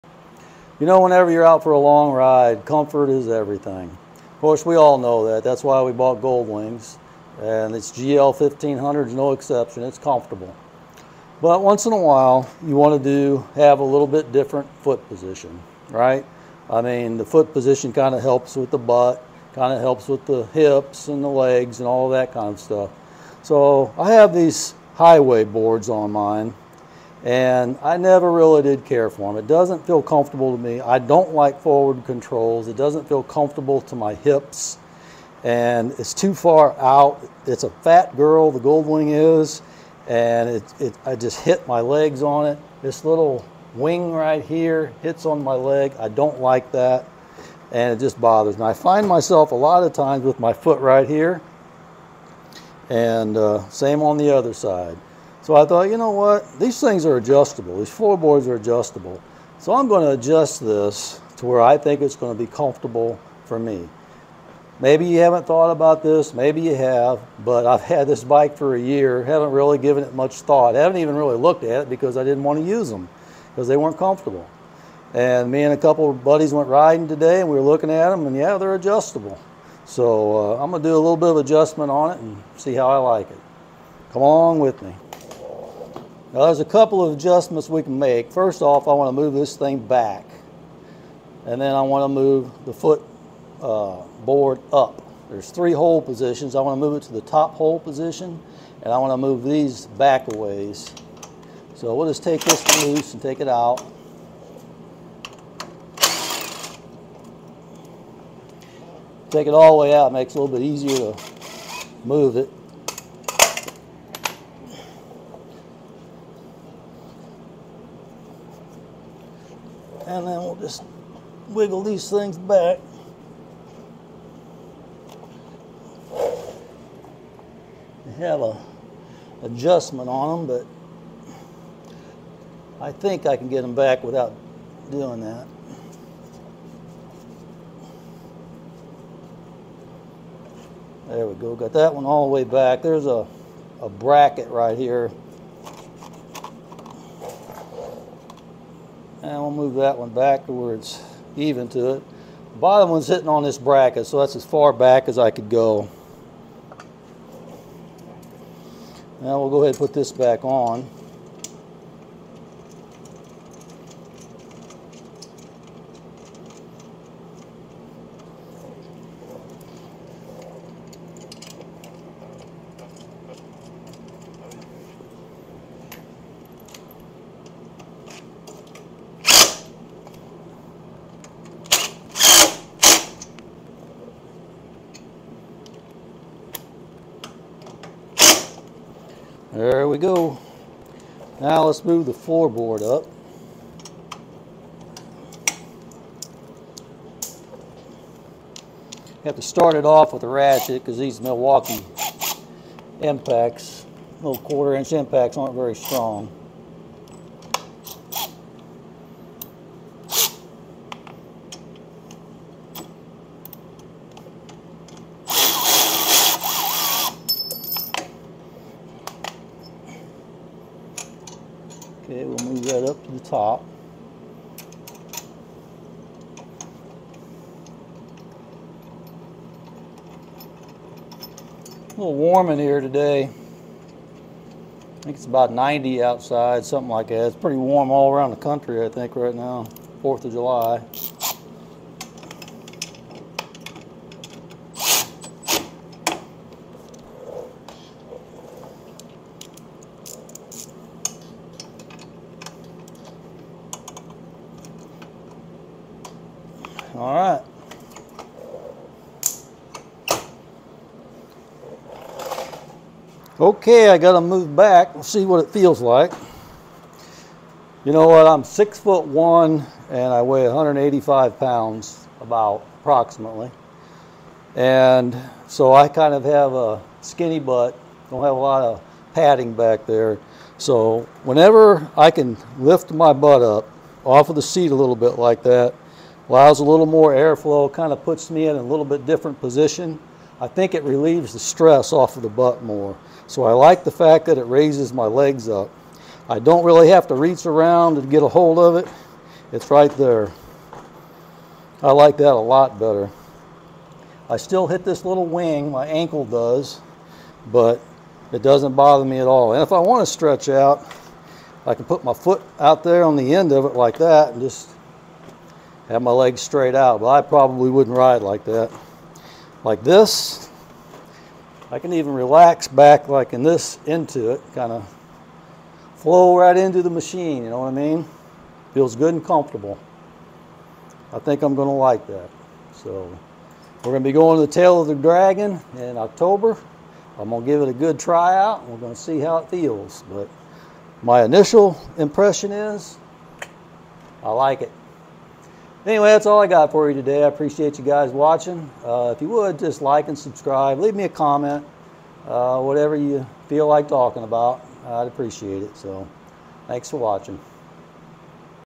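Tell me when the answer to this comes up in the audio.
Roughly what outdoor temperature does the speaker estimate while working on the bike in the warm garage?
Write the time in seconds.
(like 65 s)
235 s.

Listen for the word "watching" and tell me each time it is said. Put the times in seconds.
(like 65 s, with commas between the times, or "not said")
348 s, 356 s.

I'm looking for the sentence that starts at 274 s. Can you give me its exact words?
And so I kind of have a skinny butt, don't have a lot of padding back there.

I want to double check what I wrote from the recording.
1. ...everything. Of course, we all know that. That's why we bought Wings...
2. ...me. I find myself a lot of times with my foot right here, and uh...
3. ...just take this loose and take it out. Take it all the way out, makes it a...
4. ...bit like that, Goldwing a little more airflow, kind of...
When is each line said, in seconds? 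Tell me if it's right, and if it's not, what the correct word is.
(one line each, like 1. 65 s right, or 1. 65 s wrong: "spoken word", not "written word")
1. 3 s wrong: "Gold", not "Wings"
2. 48 s right
3. 102 s right
4. 284 s wrong: "Allows", not "Goldwing".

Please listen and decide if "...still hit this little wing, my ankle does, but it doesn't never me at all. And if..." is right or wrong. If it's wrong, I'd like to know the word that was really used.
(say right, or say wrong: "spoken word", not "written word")
wrong: "bother", not "never".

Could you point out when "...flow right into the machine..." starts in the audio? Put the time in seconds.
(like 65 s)
325 s.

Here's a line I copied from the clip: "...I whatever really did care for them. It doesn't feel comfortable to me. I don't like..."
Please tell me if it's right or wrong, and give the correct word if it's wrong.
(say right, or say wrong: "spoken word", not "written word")
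wrong: "never", not "whatever".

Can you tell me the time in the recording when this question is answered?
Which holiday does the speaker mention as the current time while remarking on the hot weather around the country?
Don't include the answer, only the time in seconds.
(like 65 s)
240 s.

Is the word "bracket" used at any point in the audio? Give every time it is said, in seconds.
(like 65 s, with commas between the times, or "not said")
143 s, 153 s.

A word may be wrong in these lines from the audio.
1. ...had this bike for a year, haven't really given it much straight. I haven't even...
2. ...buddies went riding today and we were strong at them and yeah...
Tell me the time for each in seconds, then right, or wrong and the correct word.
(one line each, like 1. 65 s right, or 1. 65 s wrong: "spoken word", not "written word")
1. 67 s wrong: "thought", not "straight"
2. 76 s wrong: "looking", not "strong".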